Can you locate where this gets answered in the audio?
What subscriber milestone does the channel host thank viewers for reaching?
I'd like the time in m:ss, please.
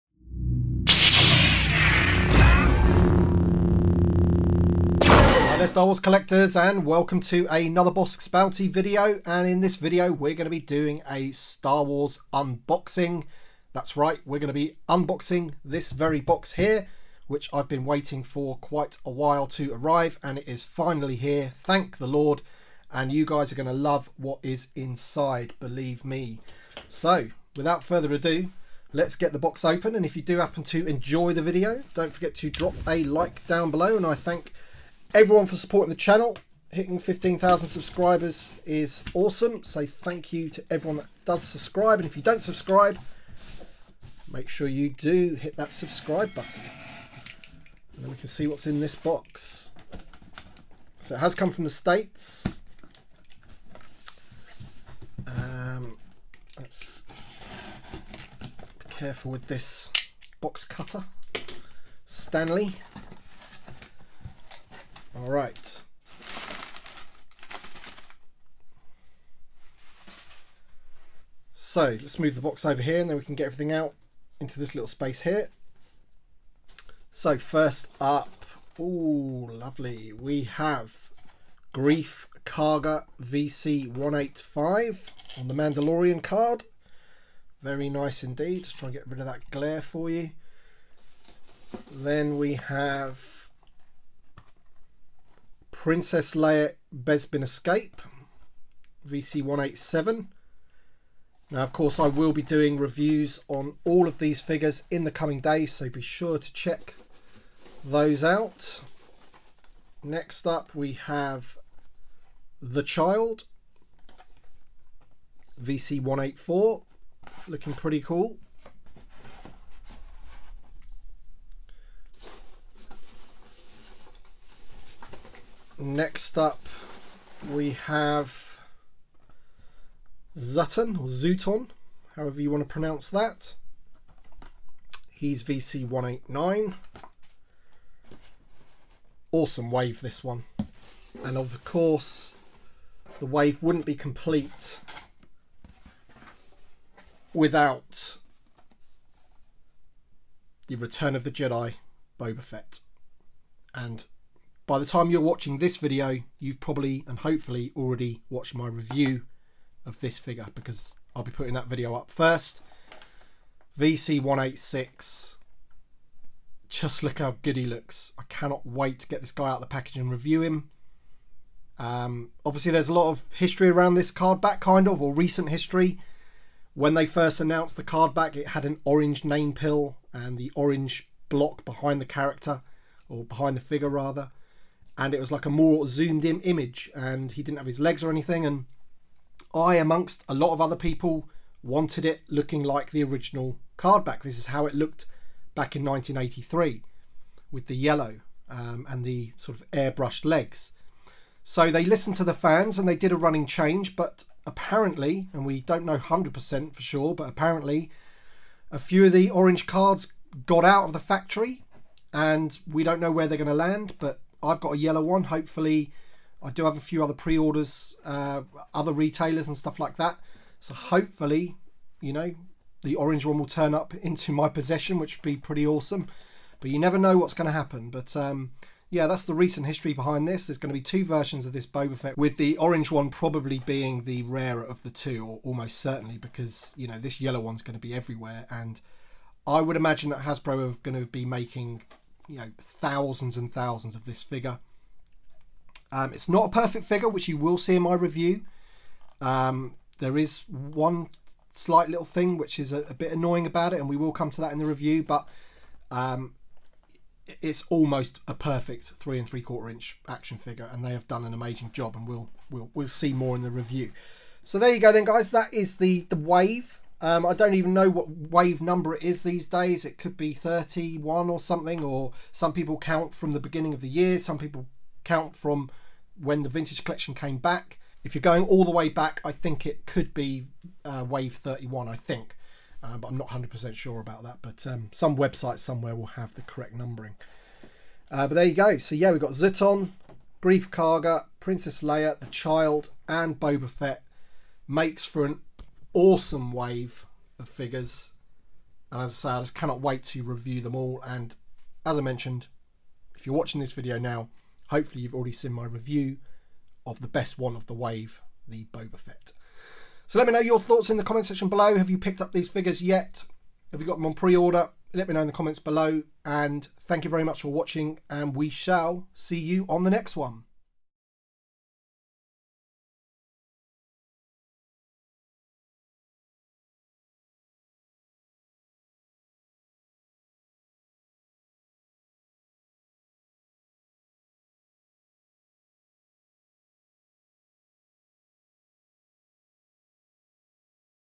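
0:36.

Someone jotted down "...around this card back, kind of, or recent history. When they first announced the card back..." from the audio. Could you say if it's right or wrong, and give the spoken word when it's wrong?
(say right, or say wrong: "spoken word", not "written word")
right.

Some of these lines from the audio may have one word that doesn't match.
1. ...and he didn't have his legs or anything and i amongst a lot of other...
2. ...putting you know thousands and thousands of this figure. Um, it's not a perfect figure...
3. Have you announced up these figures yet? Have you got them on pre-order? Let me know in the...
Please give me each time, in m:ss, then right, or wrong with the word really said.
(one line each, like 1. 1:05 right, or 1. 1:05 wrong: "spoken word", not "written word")
1. 3:06 right
2. 4:01 wrong: "making", not "putting"
3. 5:11 wrong: "picked", not "announced".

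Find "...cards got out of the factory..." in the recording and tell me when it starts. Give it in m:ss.
3:29.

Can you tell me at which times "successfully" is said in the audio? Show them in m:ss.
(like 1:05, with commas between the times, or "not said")
not said.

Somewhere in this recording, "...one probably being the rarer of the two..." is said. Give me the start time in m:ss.
3:52.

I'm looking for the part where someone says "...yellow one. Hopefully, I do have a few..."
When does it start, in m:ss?
3:34.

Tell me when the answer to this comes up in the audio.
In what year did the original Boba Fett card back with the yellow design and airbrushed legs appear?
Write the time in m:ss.
3:15.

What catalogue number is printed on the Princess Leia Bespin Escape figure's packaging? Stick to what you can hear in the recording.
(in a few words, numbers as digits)
VC187.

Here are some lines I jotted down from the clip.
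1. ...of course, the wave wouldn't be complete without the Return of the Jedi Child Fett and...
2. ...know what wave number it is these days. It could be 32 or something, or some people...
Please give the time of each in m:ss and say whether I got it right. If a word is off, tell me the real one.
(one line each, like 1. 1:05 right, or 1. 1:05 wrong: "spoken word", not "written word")
1. 2:21 wrong: "Boba", not "Child"
2. 4:27 wrong: "31", not "32".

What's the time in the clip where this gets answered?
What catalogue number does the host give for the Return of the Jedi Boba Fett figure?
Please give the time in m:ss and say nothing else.
2:43.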